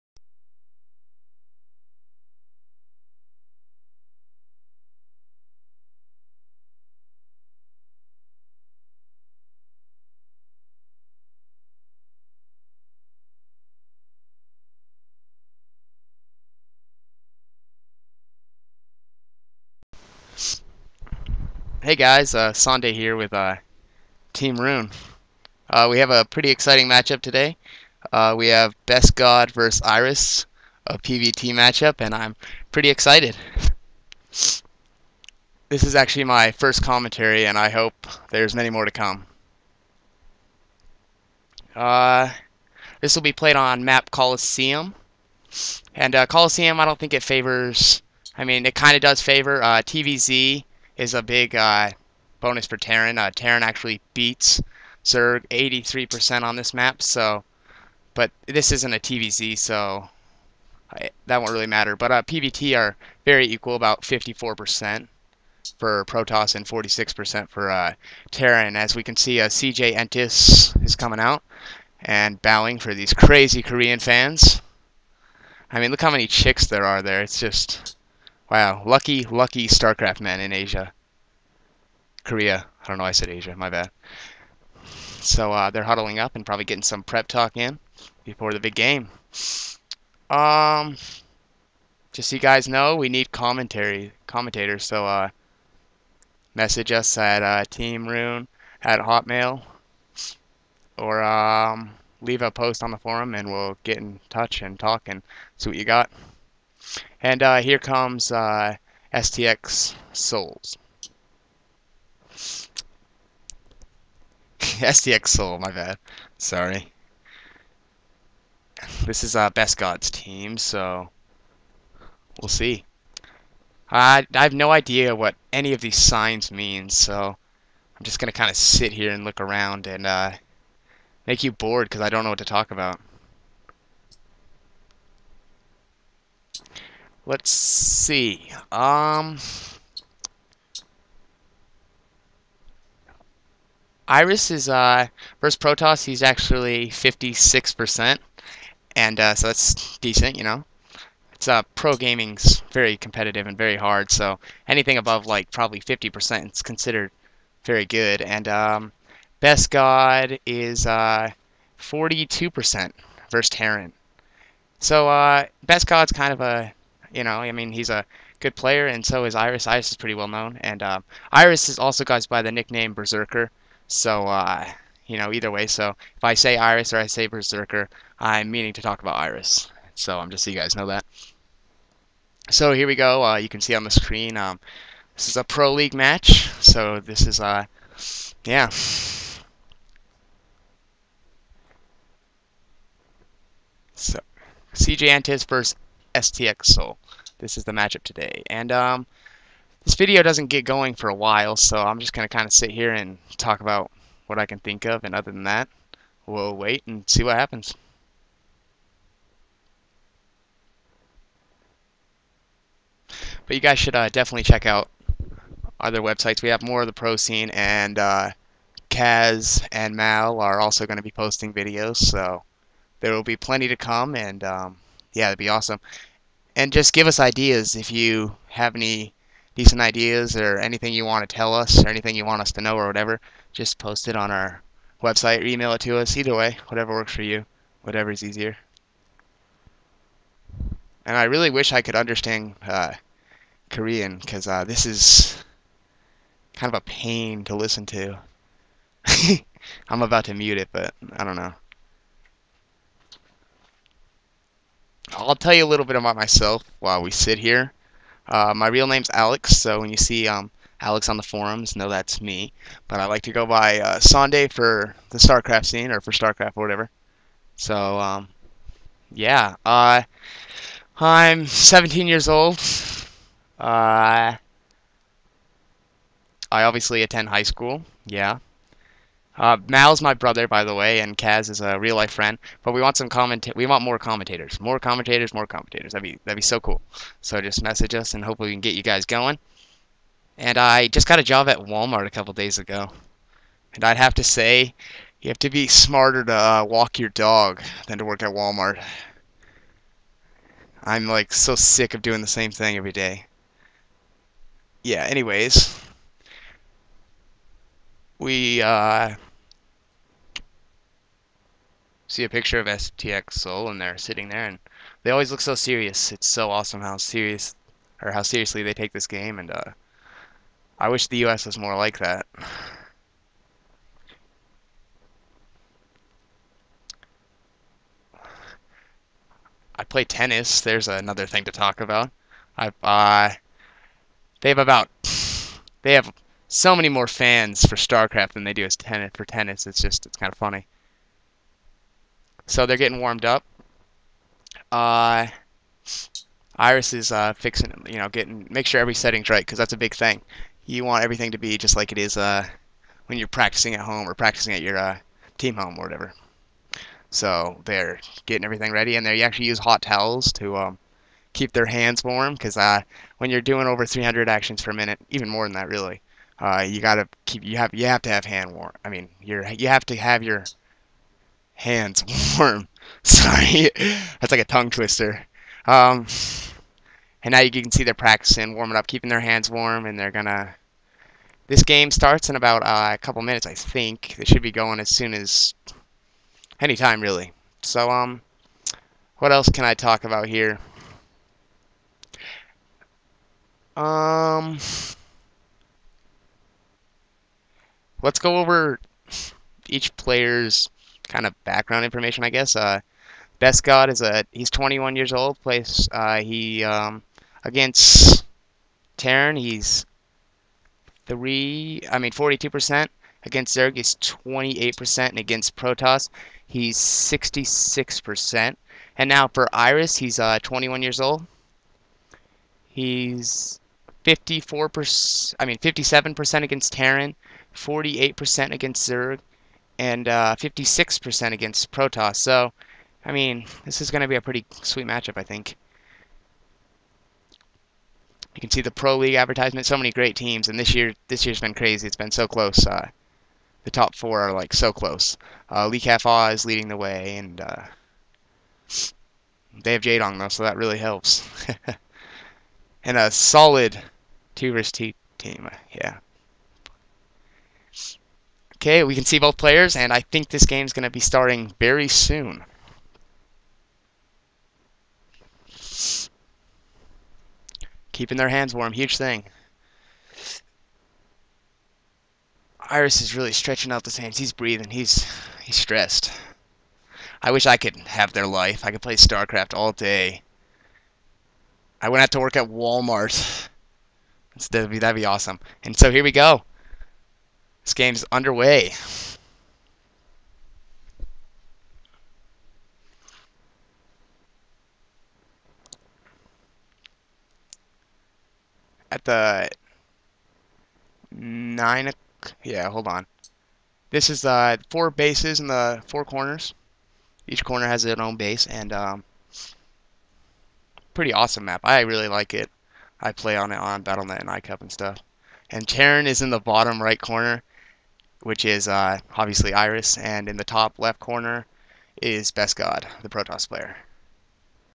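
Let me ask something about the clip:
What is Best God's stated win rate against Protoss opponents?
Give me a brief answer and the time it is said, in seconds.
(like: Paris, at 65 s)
66%, at 416 s.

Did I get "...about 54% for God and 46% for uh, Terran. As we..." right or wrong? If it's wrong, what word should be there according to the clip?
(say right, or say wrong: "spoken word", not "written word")
wrong: "Protoss", not "God".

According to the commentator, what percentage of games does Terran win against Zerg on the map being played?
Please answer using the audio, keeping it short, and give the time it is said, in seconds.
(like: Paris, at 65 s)
83%, at 55 s.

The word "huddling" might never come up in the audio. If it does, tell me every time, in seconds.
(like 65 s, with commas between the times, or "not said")
85 s.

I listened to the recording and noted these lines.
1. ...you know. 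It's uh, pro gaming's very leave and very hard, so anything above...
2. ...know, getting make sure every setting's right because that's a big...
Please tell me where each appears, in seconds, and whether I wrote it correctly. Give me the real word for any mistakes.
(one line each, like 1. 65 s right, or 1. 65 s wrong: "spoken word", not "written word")
1. 150 s wrong: "competitive", not "leave"
2. 347 s right.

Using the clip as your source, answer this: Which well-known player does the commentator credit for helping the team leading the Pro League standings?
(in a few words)
Jaedong.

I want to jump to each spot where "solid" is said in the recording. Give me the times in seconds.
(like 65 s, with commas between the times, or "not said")
453 s.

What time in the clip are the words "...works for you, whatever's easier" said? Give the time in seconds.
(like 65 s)
236 s.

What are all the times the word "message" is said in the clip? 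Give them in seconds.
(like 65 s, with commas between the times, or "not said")
96 s, 287 s.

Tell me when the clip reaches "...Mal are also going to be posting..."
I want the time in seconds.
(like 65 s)
219 s.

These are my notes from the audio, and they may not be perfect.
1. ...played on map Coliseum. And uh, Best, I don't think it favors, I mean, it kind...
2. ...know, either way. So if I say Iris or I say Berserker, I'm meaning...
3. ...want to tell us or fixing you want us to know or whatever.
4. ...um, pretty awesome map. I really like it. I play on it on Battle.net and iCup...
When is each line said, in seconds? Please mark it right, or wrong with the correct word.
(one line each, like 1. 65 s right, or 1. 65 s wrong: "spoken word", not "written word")
1. 43 s wrong: "Coliseum", not "Best"
2. 175 s right
3. 231 s wrong: "anything", not "fixing"
4. 508 s right.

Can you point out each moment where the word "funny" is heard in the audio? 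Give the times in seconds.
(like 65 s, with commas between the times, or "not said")
340 s.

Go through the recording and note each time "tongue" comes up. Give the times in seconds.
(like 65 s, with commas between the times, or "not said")
374 s.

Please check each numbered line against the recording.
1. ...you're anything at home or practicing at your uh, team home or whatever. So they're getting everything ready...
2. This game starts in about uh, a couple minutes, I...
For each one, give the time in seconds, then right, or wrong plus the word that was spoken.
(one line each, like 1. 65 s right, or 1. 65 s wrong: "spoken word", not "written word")
1. 353 s wrong: "practicing", not "anything"
2. 381 s right.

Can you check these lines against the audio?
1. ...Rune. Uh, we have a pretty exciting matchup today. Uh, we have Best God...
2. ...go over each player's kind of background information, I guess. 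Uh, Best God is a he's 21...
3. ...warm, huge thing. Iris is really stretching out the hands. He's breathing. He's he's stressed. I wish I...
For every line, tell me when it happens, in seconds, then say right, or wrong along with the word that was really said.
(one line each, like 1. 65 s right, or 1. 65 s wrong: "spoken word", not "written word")
1. 24 s right
2. 398 s right
3. 468 s right.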